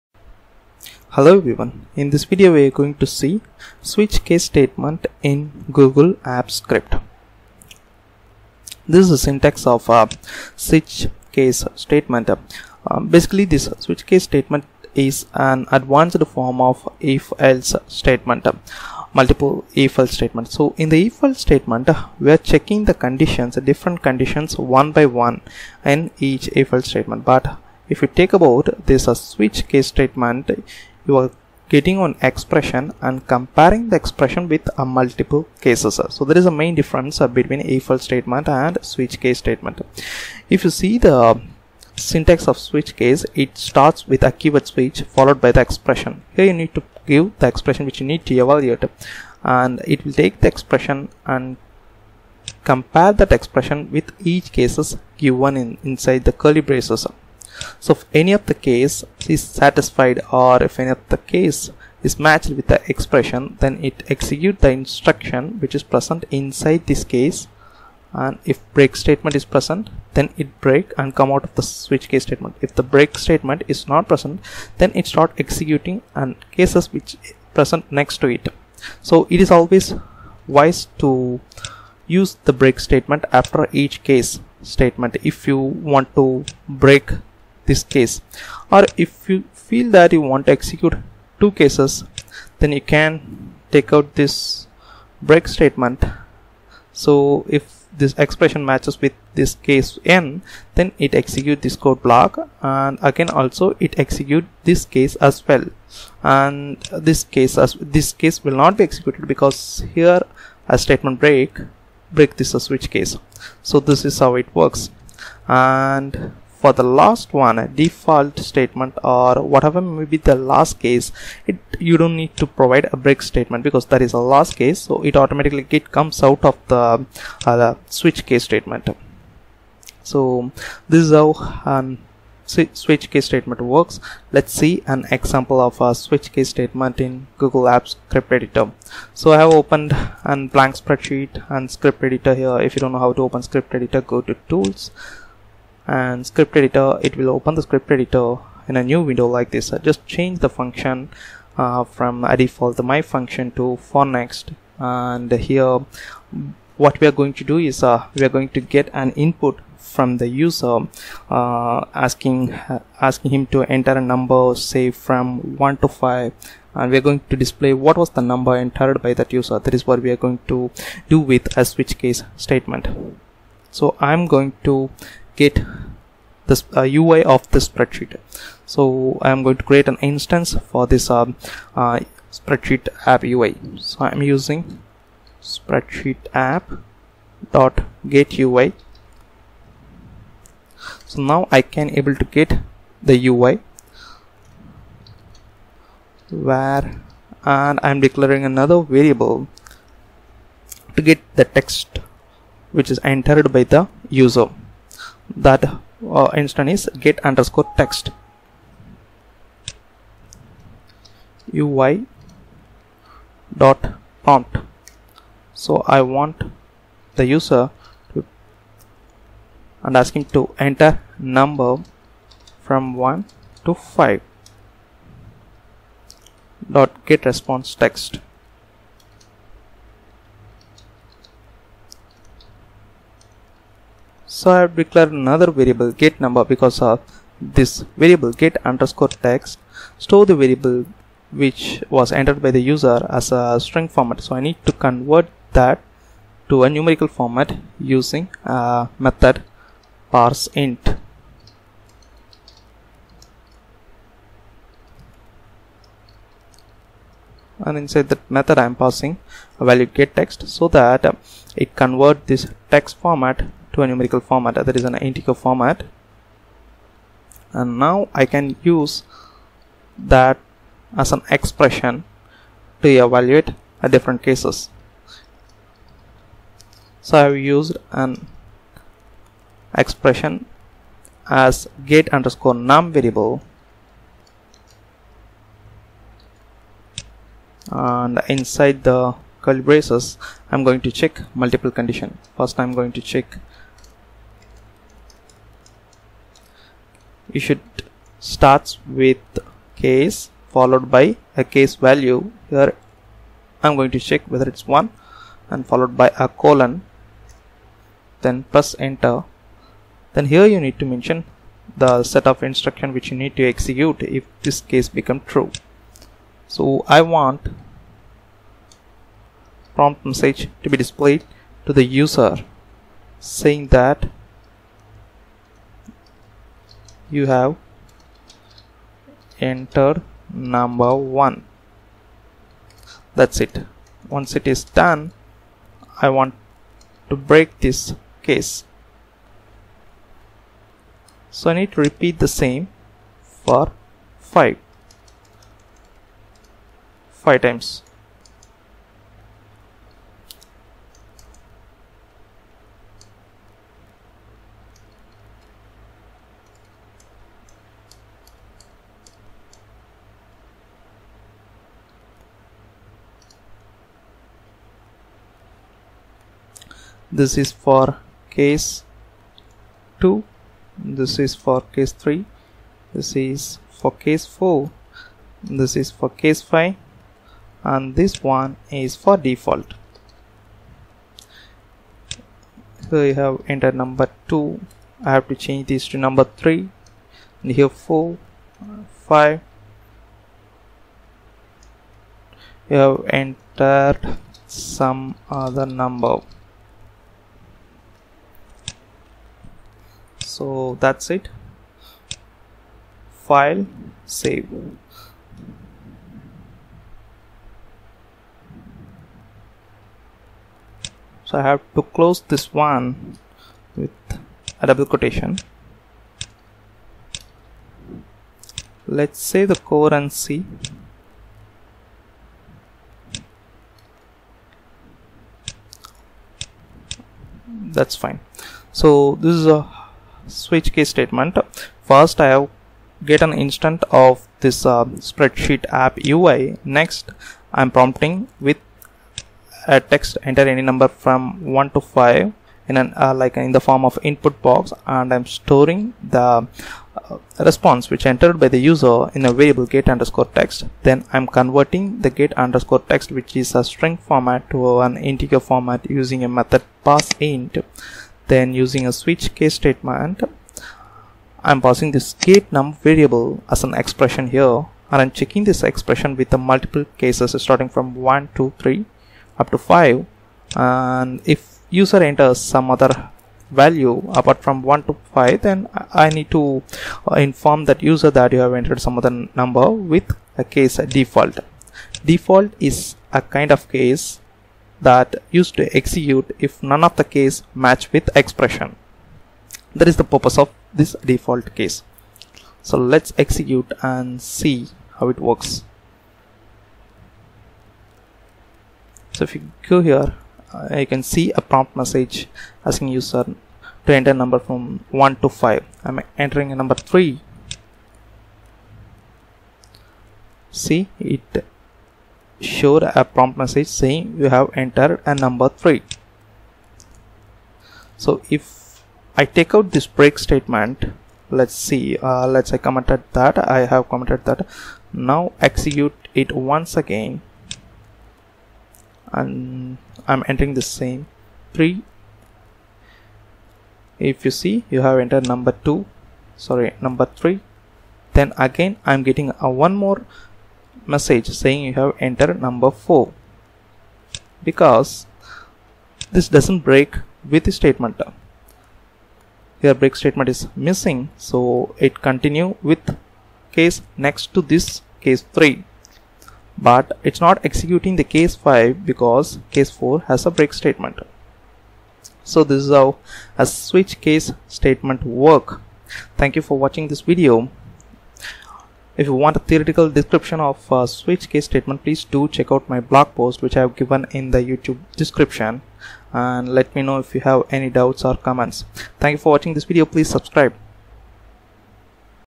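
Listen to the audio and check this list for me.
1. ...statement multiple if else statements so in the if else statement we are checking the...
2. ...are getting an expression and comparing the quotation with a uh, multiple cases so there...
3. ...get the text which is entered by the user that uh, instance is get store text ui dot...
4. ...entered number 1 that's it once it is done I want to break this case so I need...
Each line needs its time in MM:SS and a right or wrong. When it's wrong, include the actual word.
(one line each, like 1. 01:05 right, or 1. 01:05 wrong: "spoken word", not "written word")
1. 00:17 right
2. 00:31 wrong: "expression", not "quotation"
3. 03:21 wrong: "underscore", not "store"
4. 05:29 right.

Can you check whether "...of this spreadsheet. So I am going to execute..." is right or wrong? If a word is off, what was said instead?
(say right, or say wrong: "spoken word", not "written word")
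wrong: "create", not "execute".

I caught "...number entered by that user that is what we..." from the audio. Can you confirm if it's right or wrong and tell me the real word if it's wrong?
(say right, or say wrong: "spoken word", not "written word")
right.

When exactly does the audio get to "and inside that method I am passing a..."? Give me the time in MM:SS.
04:17.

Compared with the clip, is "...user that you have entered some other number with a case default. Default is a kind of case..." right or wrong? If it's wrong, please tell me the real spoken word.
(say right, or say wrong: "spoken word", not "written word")
right.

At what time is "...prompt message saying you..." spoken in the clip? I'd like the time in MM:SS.
08:33.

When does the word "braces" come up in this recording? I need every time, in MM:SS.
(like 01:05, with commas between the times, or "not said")
00:56, 04:49.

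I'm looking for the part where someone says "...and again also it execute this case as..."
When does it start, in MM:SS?
01:42.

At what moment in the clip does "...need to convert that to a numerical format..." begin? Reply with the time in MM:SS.
04:04.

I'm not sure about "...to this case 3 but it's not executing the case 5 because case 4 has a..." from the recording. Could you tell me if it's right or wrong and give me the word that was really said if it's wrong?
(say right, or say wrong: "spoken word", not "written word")
right.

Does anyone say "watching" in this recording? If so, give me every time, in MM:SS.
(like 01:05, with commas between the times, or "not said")
09:26, 09:39.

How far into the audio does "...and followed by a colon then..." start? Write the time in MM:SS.
05:05.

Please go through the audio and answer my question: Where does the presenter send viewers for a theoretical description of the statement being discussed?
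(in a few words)
blog post.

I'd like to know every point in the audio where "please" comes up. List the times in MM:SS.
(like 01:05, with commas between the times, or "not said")
09:31, 09:39.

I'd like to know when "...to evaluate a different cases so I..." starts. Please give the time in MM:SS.
04:32.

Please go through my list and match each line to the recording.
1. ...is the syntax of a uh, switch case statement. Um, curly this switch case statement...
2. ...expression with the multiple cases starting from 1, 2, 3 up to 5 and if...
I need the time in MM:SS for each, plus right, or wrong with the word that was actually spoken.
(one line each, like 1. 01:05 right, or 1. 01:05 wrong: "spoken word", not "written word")
1. 00:09 wrong: "basically", not "curly"
2. 07:45 right.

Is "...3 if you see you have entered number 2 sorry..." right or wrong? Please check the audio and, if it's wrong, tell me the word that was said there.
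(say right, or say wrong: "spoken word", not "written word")
right.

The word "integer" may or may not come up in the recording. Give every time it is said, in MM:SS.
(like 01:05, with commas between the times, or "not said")
04:24, 07:34.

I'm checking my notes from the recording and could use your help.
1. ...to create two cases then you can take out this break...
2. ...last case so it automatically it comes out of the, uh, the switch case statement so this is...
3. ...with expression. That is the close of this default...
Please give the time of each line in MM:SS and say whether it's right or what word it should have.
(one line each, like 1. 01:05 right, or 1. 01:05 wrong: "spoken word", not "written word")
1. 01:30 wrong: "execute", not "create"
2. 02:04 right
3. 08:07 wrong: "purpose", not "close".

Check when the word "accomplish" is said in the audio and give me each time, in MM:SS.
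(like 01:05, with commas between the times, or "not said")
not said.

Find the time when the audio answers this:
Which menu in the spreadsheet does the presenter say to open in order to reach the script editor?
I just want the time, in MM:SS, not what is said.
02:24.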